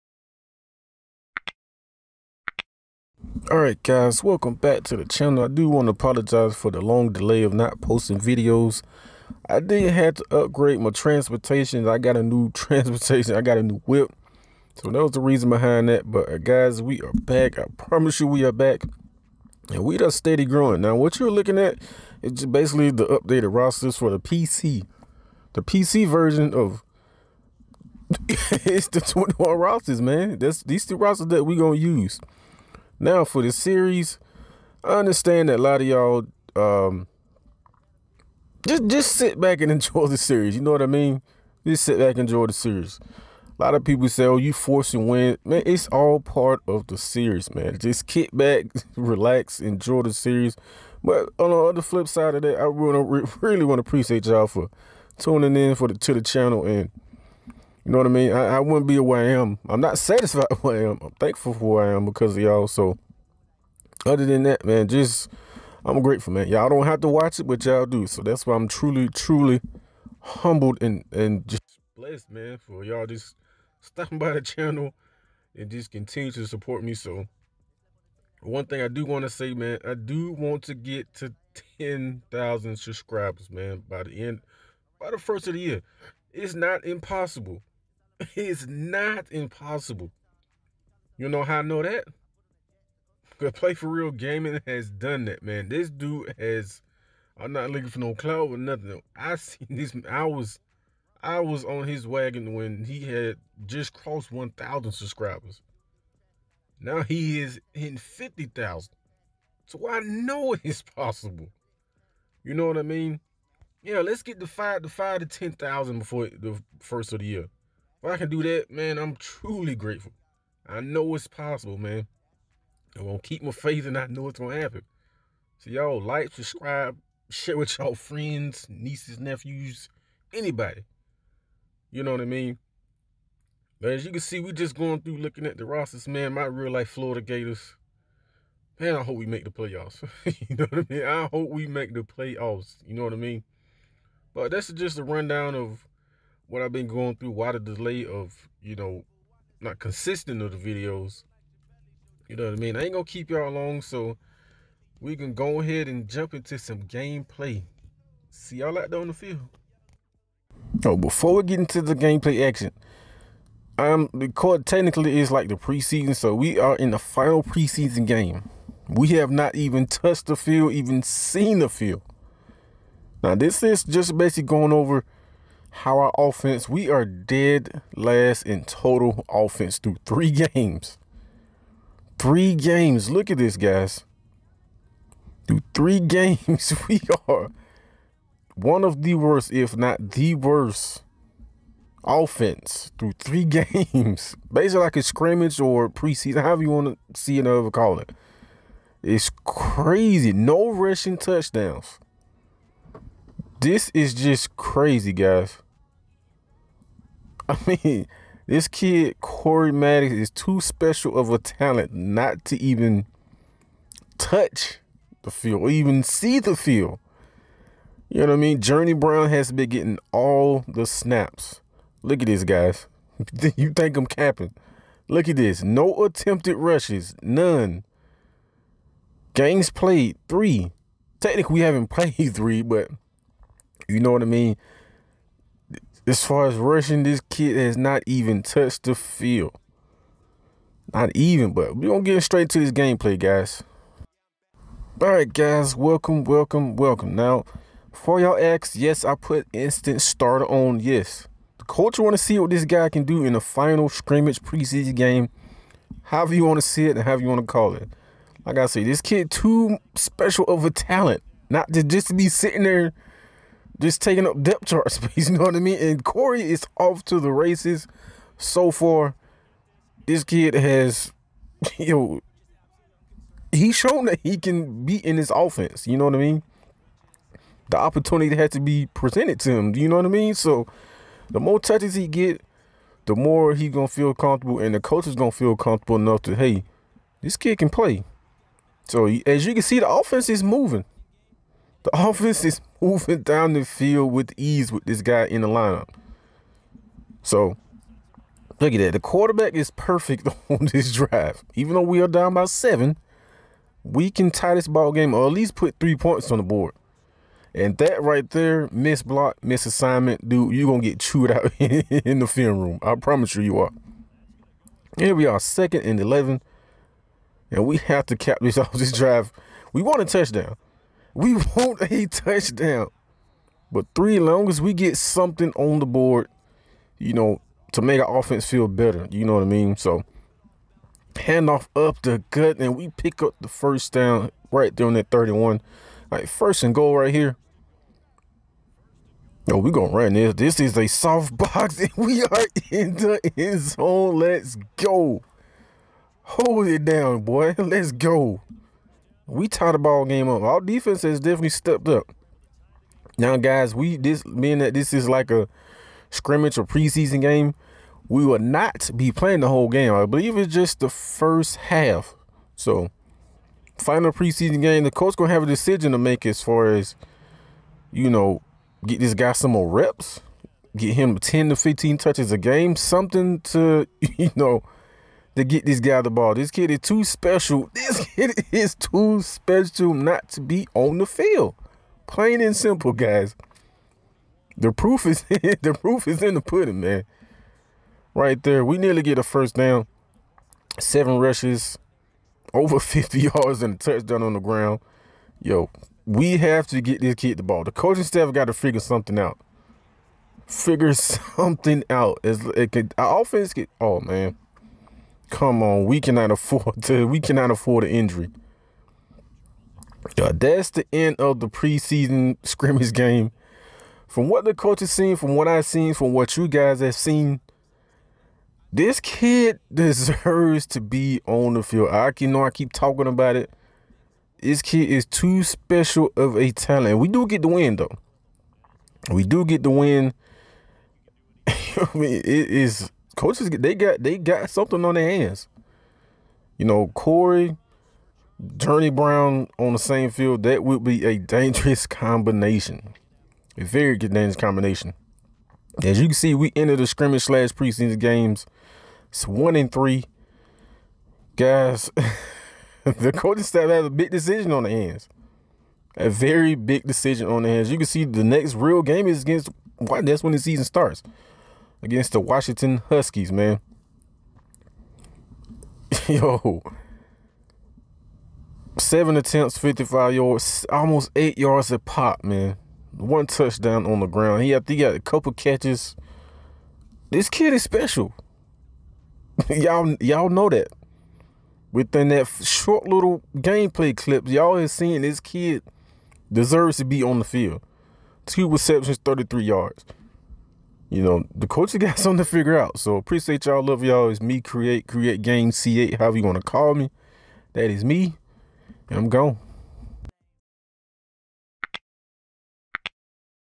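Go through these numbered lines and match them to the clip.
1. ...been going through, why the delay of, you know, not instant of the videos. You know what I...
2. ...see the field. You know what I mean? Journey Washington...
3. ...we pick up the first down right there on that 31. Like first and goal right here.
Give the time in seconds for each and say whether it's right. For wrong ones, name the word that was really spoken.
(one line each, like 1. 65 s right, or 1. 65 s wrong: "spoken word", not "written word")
1. 146 s wrong: "consistent", not "instant"
2. 216 s wrong: "Brown", not "Washington"
3. 332 s right.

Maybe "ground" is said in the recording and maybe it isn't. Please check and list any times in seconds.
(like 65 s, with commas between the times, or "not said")
394 s, 474 s.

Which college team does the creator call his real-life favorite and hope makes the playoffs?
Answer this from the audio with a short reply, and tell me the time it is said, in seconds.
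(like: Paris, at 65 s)
Florida Gators, at 136 s.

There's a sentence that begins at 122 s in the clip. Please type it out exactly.
I'm gonna keep my faith and I know it's gonna happen.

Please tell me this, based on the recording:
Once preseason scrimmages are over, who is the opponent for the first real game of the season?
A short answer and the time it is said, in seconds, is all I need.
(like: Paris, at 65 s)
Washington Huskies, at 462 s.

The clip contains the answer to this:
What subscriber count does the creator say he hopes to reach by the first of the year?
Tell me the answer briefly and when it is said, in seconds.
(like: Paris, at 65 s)
10,000, at 81 s.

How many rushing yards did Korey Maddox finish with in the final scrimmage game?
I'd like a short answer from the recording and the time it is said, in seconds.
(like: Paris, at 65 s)
55, at 469 s.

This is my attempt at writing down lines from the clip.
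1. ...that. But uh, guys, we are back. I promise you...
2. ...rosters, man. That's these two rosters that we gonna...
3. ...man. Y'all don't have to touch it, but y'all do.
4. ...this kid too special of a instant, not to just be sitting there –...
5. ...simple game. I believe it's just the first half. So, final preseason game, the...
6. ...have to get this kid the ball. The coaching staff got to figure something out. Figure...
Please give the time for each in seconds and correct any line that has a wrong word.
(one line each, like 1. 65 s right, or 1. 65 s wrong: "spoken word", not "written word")
1. 15 s right
2. 29 s right
3. 66 s wrong: "watch", not "touch"
4. 258 s wrong: "talent", not "instant"
5. 359 s wrong: "whole", not "simple"
6. 396 s right.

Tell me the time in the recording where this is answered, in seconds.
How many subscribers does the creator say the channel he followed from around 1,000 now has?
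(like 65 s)
107 s.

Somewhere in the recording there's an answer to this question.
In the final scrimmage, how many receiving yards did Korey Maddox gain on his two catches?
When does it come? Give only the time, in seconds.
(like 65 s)
489 s.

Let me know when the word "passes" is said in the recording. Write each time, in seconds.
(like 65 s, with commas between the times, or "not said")
not said.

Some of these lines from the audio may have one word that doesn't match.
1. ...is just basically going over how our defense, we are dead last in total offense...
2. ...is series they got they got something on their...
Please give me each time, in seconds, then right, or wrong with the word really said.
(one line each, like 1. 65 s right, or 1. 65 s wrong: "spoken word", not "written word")
1. 173 s wrong: "offense", not "defense"
2. 432 s wrong: "coaches", not "series".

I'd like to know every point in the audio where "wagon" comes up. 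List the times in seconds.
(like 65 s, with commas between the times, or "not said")
102 s.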